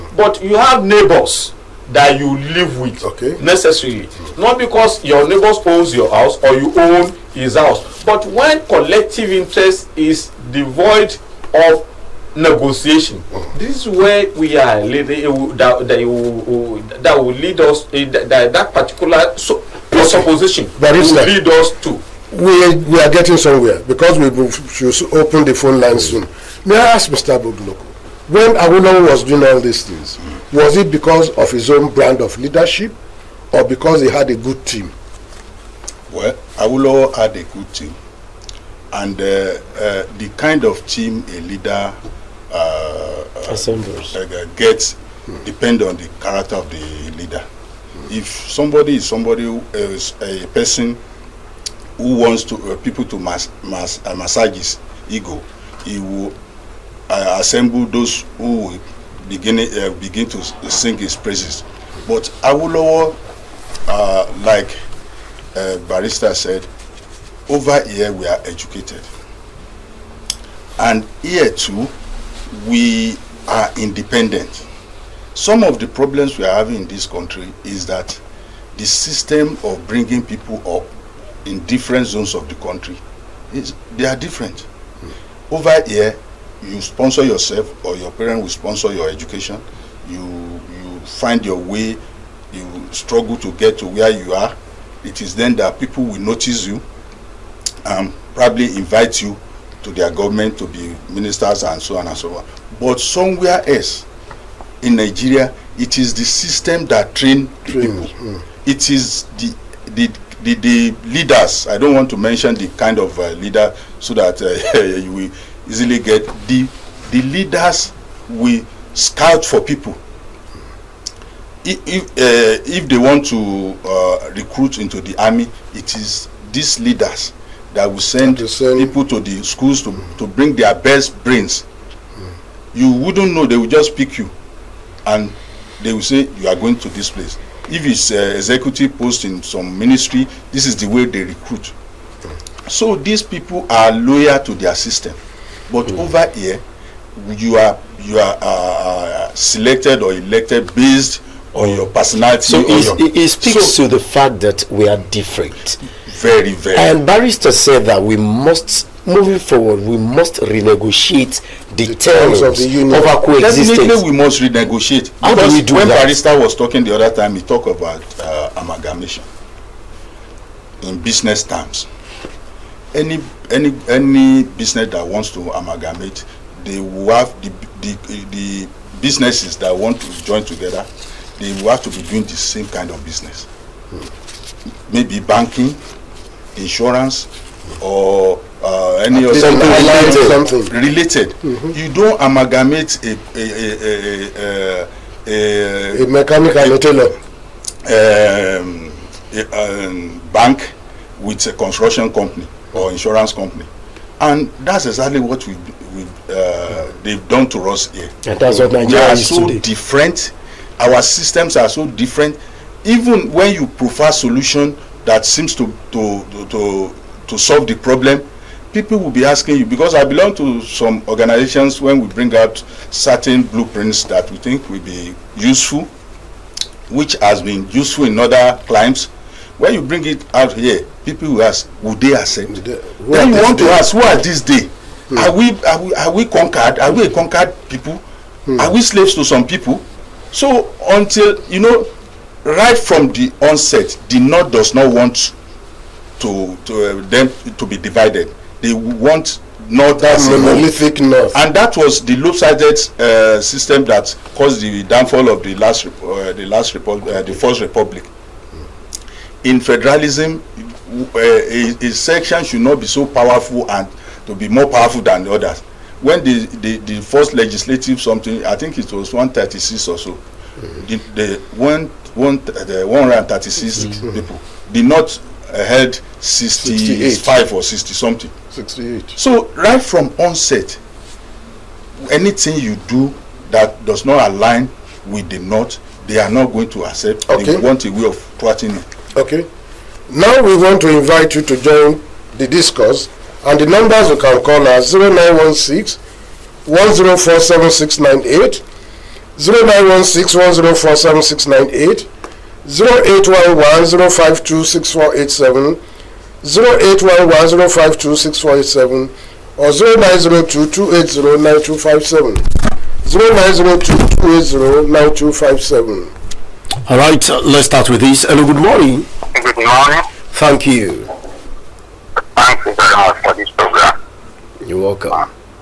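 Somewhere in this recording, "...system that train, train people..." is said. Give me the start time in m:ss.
1:46.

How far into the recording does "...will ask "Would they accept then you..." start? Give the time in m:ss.
3:51.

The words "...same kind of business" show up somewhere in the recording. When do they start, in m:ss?
3:02.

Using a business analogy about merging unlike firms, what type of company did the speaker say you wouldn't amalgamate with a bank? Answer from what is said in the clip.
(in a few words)
Construction company.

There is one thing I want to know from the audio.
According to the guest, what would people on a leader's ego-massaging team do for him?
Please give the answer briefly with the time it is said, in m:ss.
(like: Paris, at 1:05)
Sing his praises, at 1:00.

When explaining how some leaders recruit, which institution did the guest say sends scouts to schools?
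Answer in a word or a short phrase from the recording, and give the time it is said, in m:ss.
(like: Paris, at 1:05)
The army, at 2:05.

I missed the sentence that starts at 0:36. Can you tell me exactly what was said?
Well, Awolowo had a good team, and uh, uh, the kind of team a leader uh, assembles.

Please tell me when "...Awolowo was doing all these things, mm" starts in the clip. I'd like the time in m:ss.
0:28.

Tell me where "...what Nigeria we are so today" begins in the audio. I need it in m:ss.
3:28.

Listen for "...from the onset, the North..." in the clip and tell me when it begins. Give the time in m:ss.
4:02.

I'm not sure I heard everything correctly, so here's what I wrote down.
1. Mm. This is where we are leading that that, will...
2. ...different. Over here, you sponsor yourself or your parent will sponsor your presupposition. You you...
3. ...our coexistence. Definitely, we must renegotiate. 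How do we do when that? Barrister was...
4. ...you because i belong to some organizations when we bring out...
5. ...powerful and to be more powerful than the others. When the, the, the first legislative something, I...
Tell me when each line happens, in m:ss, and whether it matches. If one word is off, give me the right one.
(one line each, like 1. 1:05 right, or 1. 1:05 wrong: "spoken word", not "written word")
1. 0:13 right
2. 1:24 wrong: "education", not "presupposition"
3. 2:43 right
4. 3:39 right
5. 4:23 right.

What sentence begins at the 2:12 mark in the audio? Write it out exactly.
You wouldn't know, they will just pick you and they will say, You are going to this place.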